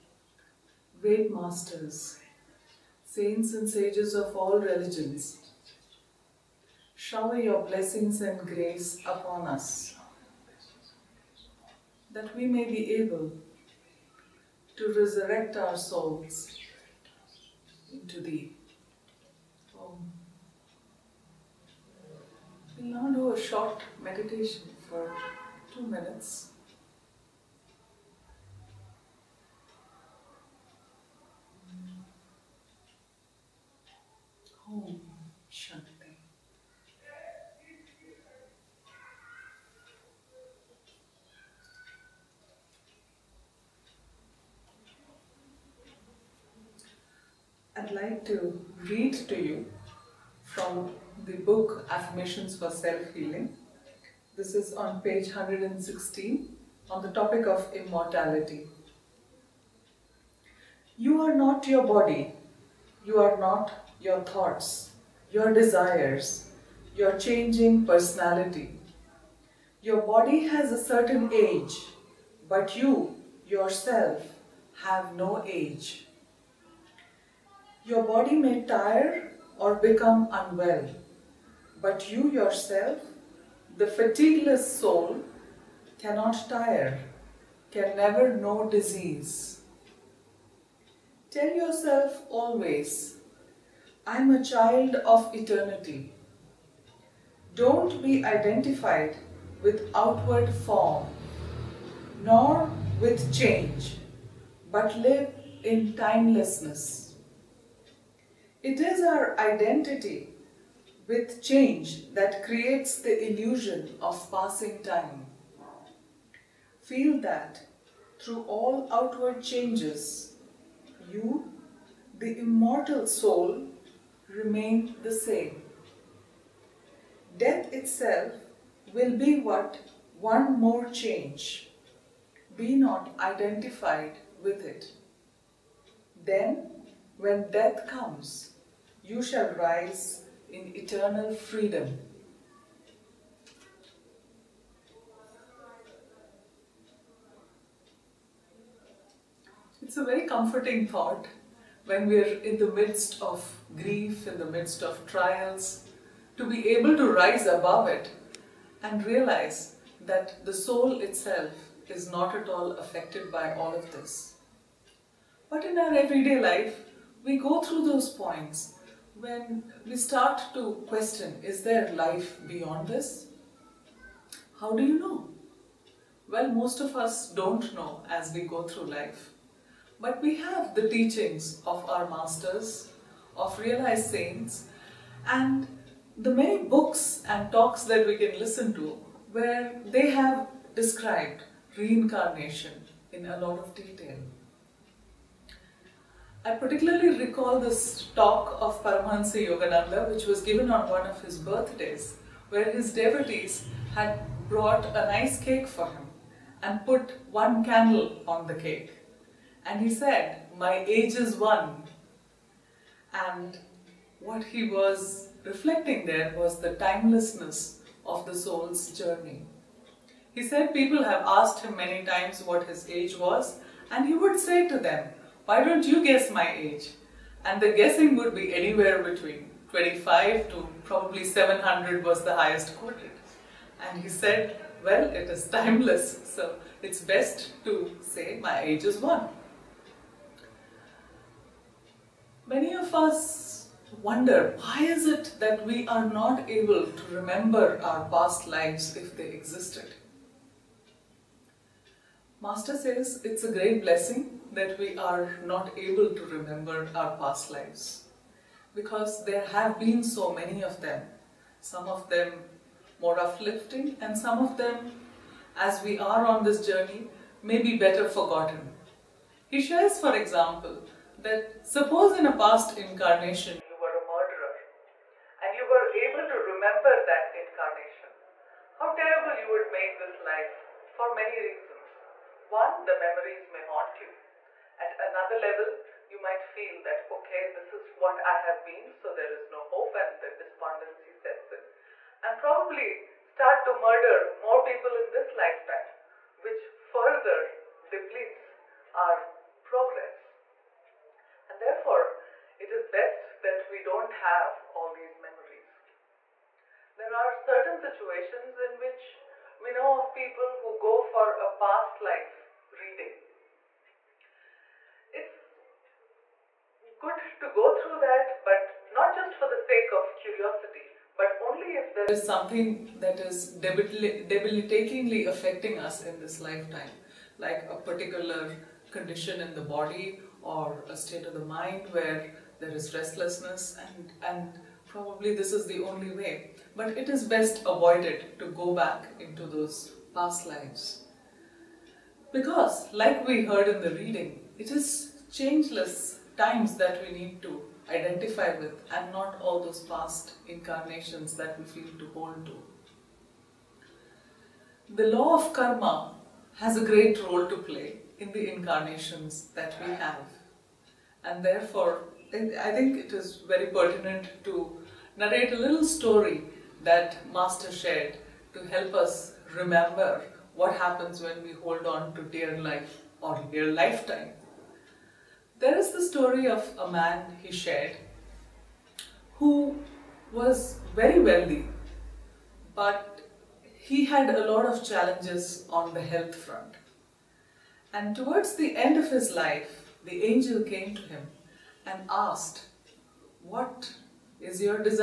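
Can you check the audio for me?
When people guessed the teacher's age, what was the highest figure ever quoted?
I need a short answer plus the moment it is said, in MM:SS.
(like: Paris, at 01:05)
700, at 03:51.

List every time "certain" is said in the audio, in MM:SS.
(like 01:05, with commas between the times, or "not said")
01:10, 05:07.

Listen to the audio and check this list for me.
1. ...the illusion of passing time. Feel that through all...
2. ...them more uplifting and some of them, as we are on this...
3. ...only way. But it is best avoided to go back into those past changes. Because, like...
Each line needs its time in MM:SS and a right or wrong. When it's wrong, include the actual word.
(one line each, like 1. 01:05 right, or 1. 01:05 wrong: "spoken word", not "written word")
1. 01:53 right
2. 04:22 right
3. 05:35 wrong: "lives", not "changes".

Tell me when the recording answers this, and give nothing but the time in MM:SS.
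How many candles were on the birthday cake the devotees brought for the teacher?
03:27.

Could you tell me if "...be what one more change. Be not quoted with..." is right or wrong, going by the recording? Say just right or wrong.
wrong.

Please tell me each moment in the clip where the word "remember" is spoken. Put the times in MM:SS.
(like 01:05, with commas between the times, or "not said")
04:07, 04:16, 04:36, 06:09.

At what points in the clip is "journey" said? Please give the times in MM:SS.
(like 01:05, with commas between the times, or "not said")
03:38, 04:26.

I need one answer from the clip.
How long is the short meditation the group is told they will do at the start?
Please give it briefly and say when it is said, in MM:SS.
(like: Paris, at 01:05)
2 minutes, at 00:25.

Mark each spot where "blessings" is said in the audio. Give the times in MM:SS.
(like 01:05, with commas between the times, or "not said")
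00:07, 04:13.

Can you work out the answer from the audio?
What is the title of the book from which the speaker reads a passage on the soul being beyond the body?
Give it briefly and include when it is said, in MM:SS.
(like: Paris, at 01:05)
Affirmations for Self Healing, at 00:51.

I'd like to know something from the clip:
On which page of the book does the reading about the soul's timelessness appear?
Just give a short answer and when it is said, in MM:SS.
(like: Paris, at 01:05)
116, at 00:55.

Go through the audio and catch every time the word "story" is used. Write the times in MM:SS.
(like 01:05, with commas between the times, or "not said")
06:05, 06:16.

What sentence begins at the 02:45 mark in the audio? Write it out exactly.
But in our everyday life, we go through those points when we start to question, is there life beyond this?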